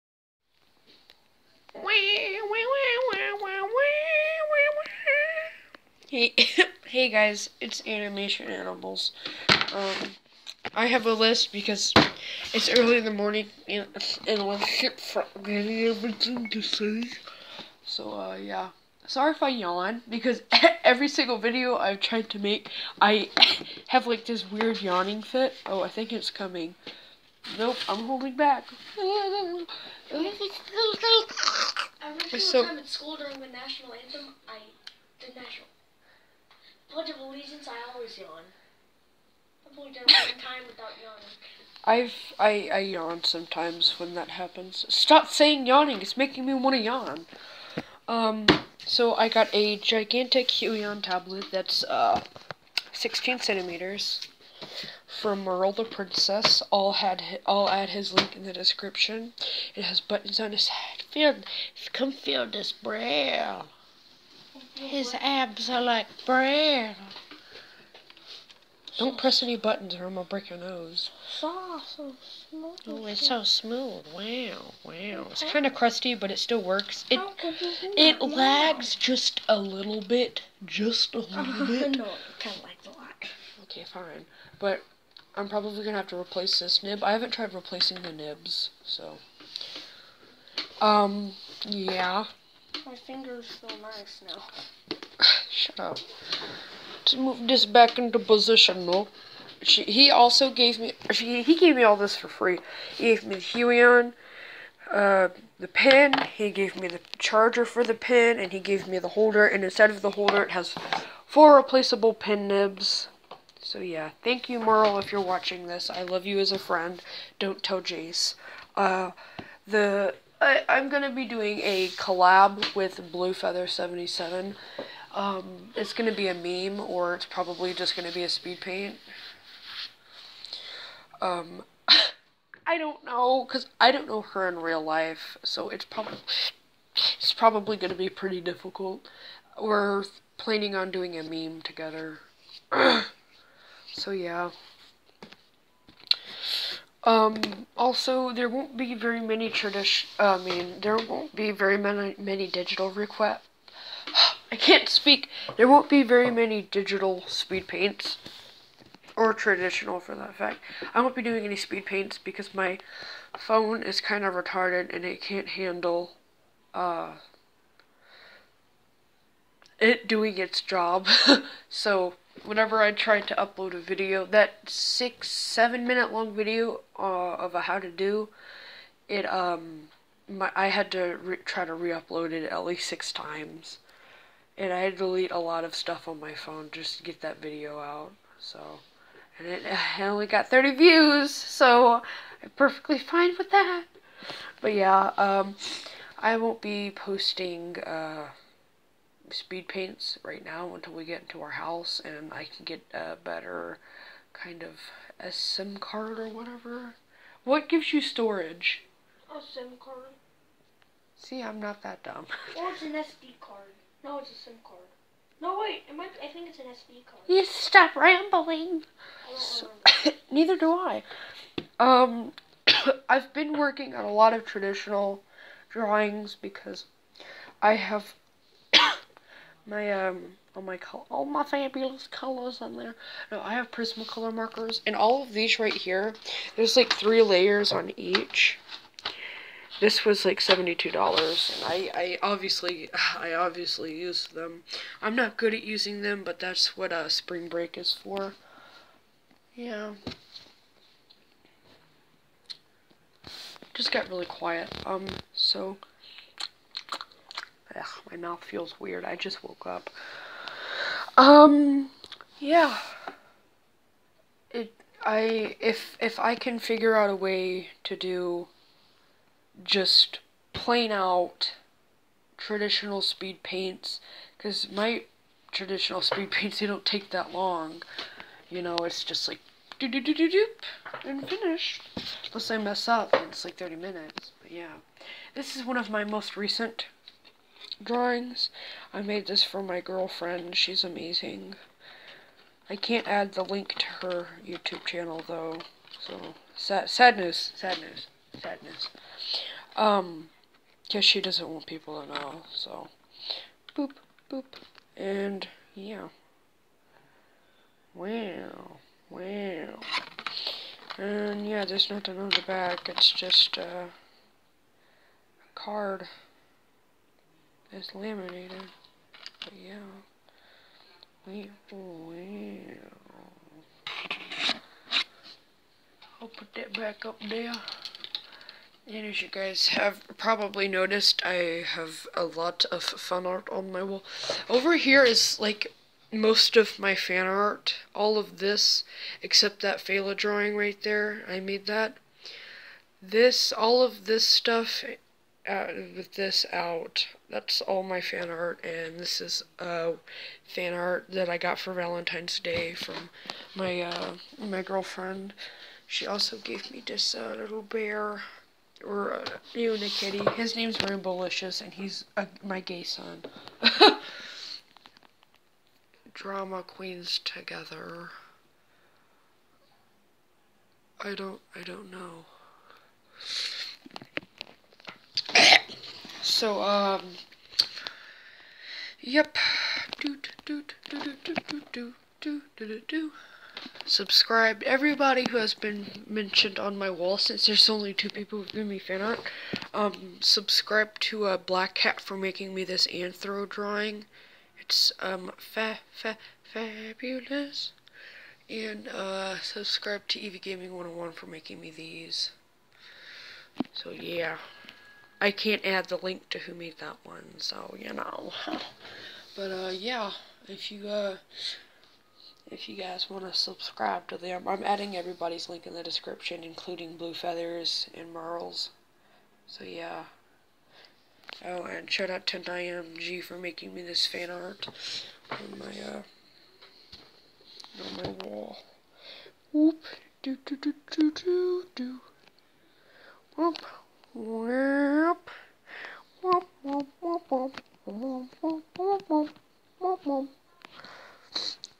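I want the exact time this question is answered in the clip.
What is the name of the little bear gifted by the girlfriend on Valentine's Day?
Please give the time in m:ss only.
6:00.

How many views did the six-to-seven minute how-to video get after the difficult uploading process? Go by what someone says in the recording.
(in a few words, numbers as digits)
30.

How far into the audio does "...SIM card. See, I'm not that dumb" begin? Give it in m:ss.
3:29.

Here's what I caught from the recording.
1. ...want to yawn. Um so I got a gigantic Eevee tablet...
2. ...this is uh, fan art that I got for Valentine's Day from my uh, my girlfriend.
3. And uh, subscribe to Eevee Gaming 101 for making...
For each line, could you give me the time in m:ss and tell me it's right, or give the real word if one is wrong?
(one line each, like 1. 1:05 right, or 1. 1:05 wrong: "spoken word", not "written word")
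1. 0:46 wrong: "Huion", not "Eevee"
2. 5:48 right
3. 6:38 right.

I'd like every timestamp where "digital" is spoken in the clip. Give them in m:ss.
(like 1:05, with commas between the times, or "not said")
2:32, 2:36.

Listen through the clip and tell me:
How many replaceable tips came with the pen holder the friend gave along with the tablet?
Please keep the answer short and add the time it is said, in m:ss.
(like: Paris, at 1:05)
4, at 1:51.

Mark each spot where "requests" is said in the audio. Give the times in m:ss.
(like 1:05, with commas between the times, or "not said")
2:32.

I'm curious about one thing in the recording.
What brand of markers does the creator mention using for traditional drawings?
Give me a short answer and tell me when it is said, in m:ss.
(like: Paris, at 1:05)
Prismacolor, at 3:53.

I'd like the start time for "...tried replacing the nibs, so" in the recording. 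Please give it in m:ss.
1:27.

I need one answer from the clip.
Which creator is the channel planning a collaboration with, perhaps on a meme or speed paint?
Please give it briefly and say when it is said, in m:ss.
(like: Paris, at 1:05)
Blue Feather 77, at 2:03.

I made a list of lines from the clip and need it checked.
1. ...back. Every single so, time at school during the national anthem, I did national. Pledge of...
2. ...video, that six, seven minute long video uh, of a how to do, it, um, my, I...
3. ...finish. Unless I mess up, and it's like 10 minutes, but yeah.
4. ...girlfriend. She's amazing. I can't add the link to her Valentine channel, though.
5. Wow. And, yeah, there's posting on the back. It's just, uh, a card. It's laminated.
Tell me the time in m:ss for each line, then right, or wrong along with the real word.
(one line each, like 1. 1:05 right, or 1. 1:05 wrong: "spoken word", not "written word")
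1. 0:28 right
2. 2:53 right
3. 4:41 wrong: "30", not "10"
4. 4:49 wrong: "YouTube", not "Valentine"
5. 5:09 wrong: "nothing", not "posting".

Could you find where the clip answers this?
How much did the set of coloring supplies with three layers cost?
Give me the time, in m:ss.
4:00.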